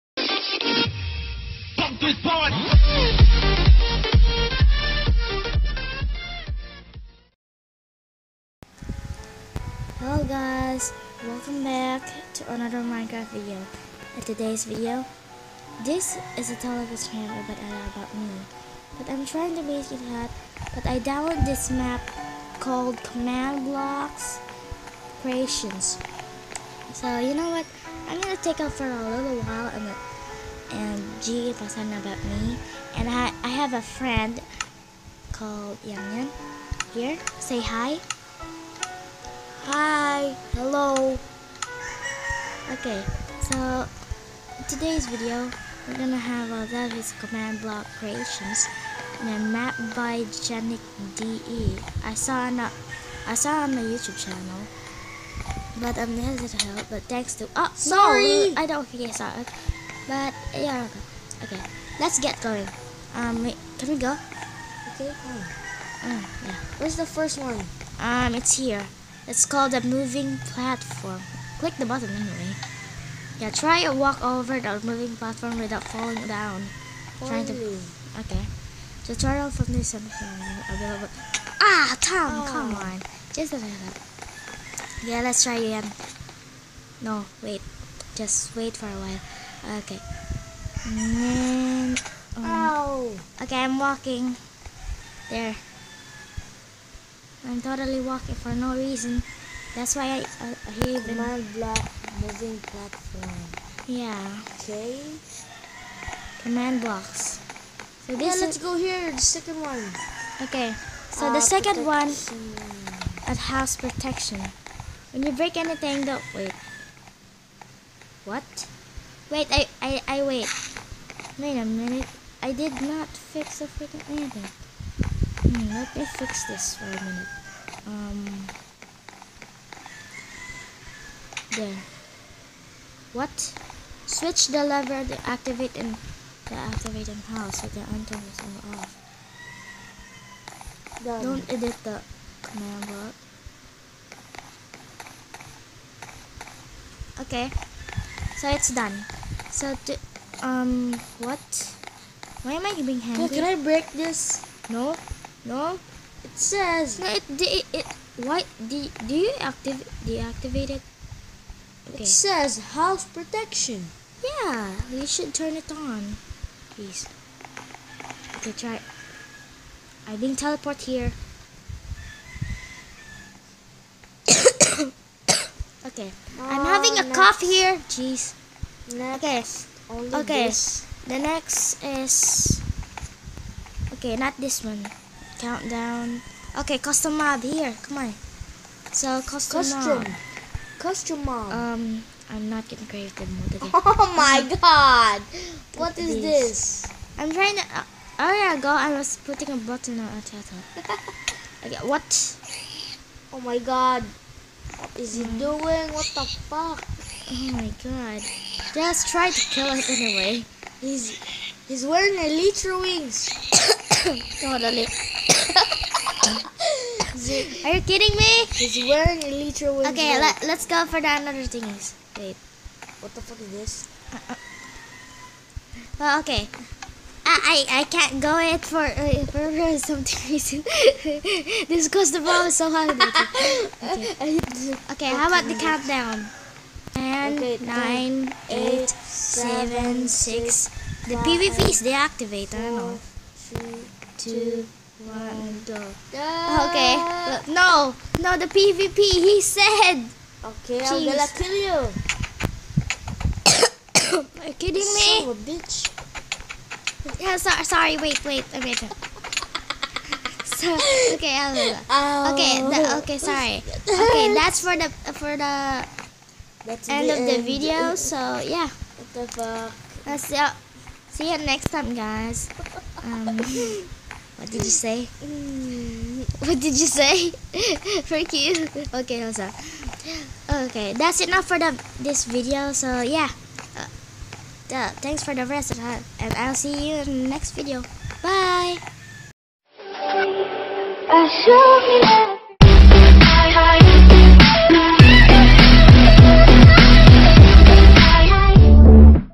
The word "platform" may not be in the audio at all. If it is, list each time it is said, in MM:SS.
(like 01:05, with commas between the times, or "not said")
01:10, 01:15, 01:42.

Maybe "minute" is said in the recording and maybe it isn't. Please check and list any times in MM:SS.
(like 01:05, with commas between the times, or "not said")
02:01, 02:06.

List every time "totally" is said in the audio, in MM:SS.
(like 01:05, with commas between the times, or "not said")
01:37, 03:34.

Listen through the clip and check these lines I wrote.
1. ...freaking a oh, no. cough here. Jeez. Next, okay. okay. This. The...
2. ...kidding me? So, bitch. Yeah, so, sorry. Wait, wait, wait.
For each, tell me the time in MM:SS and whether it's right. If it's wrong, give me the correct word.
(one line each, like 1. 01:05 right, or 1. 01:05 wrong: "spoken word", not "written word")
1. 02:56 wrong: "having", not "freaking"
2. 04:14 right.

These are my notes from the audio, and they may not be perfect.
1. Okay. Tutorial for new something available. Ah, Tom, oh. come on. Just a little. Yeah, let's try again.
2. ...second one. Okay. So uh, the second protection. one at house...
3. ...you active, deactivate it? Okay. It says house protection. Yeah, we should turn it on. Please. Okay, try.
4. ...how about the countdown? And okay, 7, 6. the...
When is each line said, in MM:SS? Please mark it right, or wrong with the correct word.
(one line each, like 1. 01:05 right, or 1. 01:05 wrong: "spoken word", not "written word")
1. 01:18 right
2. 01:49 right
3. 02:39 right
4. 03:55 right.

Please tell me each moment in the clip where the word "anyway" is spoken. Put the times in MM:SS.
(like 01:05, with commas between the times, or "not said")
01:12, 03:29.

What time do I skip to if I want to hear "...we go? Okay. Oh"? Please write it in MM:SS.
01:03.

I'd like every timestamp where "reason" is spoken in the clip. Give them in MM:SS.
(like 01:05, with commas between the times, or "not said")
01:38, 03:50.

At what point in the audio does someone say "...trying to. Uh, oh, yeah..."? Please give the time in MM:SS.
03:17.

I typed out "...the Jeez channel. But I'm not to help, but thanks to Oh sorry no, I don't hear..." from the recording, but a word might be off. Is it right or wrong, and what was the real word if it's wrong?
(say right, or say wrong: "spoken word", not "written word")
wrong: "YouTube", not "Jeez".